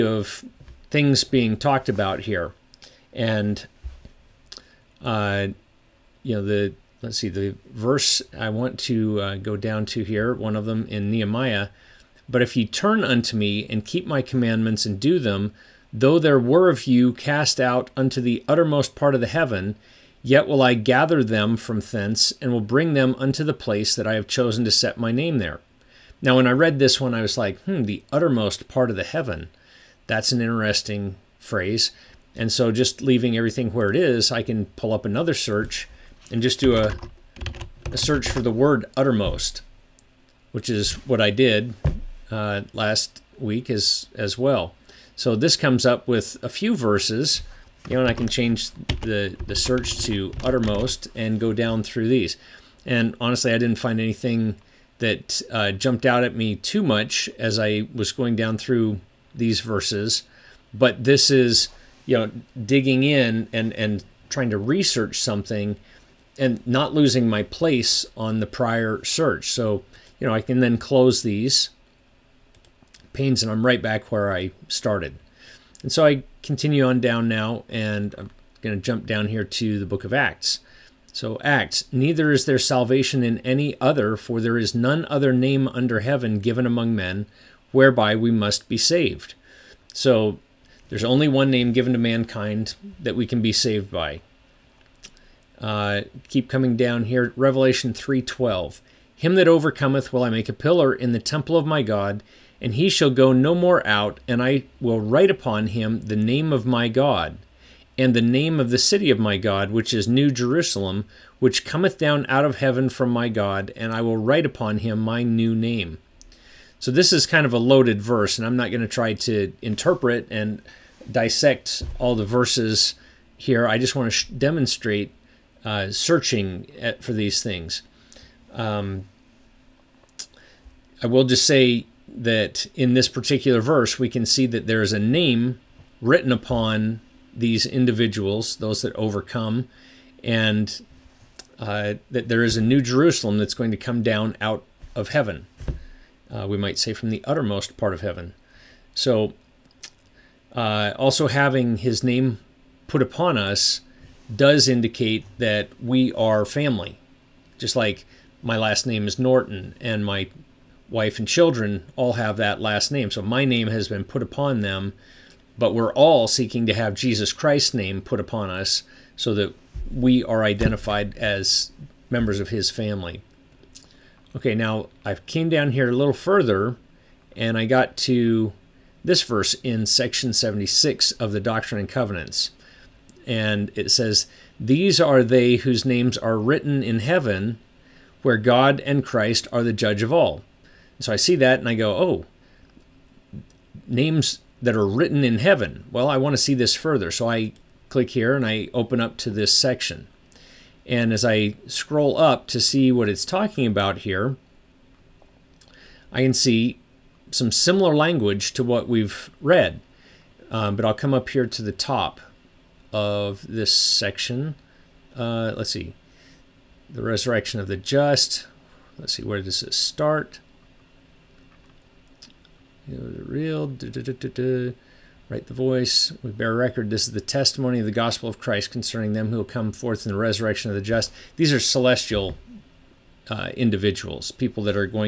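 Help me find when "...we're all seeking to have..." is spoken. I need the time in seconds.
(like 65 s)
165 s.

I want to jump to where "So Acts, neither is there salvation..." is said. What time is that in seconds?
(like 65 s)
81 s.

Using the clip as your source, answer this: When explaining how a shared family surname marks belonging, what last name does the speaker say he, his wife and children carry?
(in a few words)
Norton.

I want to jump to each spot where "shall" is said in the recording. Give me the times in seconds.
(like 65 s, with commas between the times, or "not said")
102 s.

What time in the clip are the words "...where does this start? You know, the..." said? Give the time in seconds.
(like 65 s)
219 s.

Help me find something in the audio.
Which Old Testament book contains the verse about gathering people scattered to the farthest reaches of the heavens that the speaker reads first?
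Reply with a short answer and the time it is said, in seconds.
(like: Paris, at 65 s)
Nehemiah, at 11 s.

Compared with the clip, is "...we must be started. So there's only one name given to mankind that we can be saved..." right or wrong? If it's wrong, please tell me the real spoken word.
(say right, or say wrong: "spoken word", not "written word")
wrong: "saved", not "started".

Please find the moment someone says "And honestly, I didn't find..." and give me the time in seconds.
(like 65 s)
52 s.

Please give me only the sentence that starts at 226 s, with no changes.
This is the testimony of the gospel of Christ concerning them who will come forth in the resurrection of the just.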